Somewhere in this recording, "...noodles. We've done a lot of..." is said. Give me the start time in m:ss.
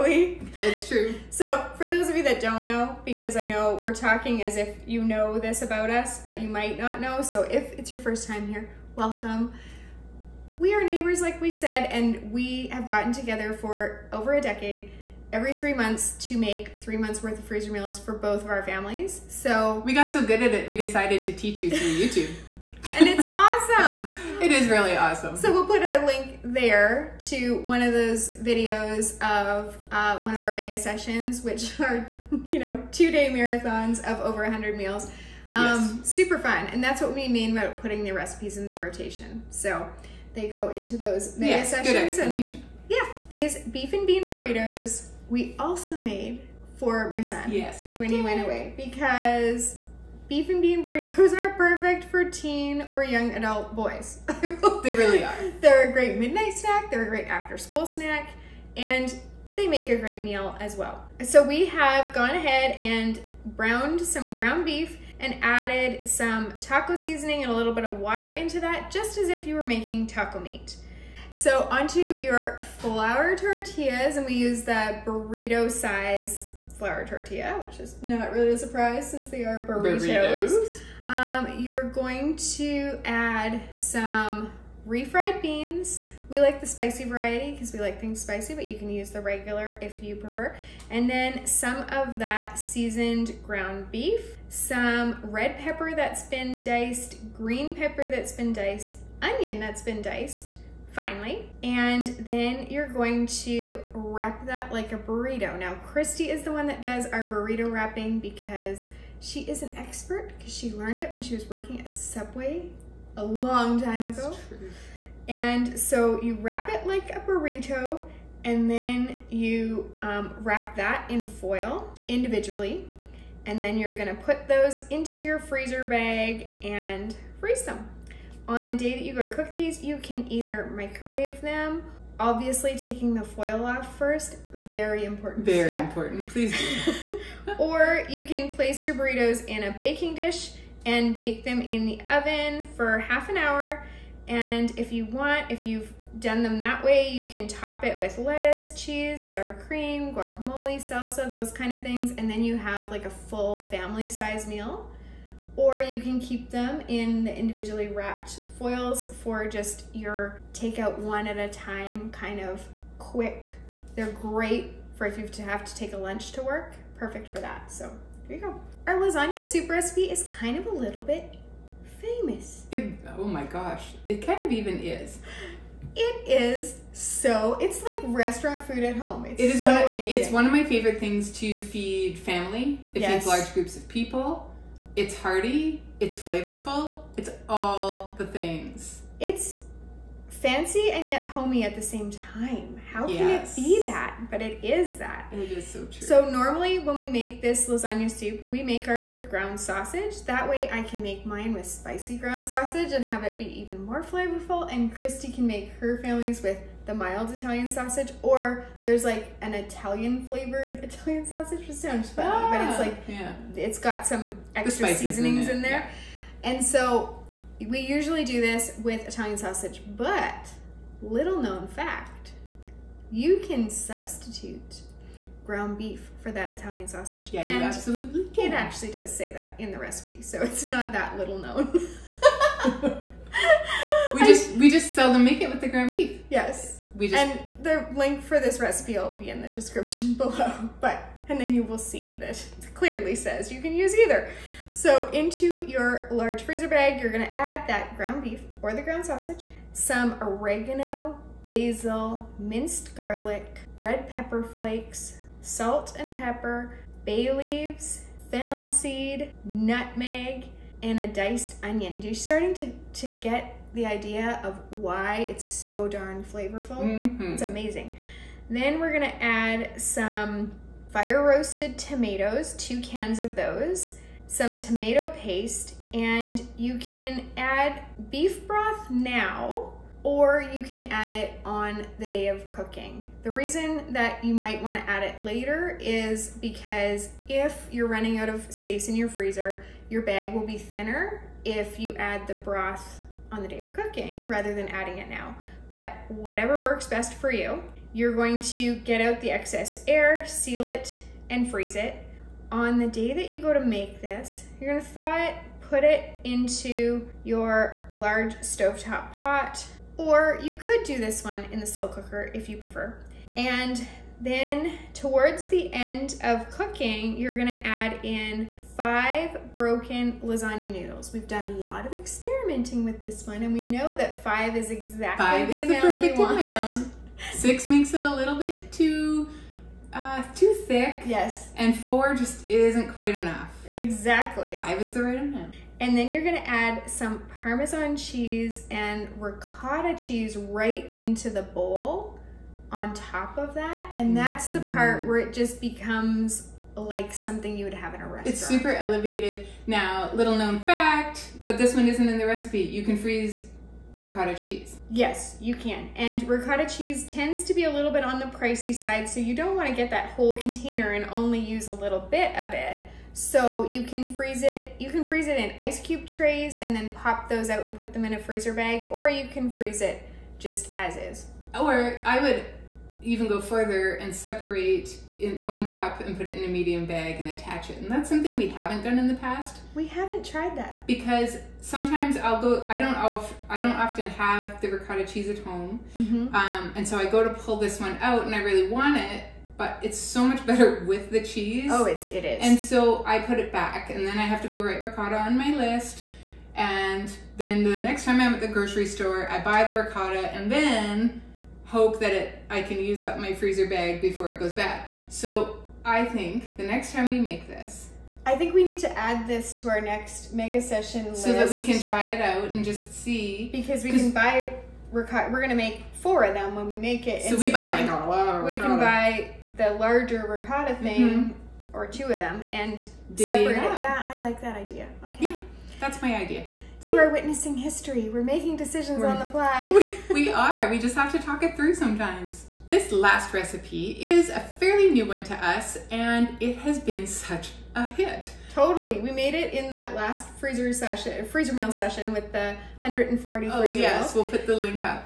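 5:20.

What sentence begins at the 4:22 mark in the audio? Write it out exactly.
You're starting to, to get the idea of why it's so darn flavorful.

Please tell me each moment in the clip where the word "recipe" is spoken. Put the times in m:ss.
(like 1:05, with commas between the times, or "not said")
0:38, 2:49, 3:49, 3:58, 5:52, 7:13.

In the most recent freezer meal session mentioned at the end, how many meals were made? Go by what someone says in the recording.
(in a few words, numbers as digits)
140.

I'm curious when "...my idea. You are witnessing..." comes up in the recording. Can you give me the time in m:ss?
7:06.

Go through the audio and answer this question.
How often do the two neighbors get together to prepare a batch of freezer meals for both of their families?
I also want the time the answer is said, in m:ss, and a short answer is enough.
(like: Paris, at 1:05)
Every three months, at 0:15.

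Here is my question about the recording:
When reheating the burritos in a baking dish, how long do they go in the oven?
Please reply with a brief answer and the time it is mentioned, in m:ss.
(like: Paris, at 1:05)
Half an hour, at 2:22.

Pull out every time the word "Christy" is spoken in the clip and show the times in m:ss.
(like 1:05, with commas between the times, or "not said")
1:45, 3:24.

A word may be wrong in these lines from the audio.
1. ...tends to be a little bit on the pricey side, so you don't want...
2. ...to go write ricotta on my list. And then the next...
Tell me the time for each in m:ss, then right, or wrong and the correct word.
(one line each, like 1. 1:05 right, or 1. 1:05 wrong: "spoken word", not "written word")
1. 5:57 right
2. 6:34 right.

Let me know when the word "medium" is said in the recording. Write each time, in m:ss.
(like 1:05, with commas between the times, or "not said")
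6:16.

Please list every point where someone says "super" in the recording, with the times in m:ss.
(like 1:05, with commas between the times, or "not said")
0:36, 5:48.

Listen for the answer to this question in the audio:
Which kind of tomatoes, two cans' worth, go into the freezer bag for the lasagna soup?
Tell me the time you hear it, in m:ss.
4:30.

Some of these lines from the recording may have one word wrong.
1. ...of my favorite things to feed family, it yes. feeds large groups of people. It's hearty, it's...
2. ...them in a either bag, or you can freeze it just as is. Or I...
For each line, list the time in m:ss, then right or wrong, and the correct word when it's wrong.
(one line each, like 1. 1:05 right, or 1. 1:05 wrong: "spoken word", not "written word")
1. 3:00 right
2. 6:07 wrong: "freezer", not "either".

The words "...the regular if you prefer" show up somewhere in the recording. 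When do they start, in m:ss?
1:29.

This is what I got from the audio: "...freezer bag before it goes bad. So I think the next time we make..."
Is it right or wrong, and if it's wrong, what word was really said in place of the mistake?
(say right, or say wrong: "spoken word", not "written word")
right.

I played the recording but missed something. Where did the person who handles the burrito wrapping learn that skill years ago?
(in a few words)
Subway.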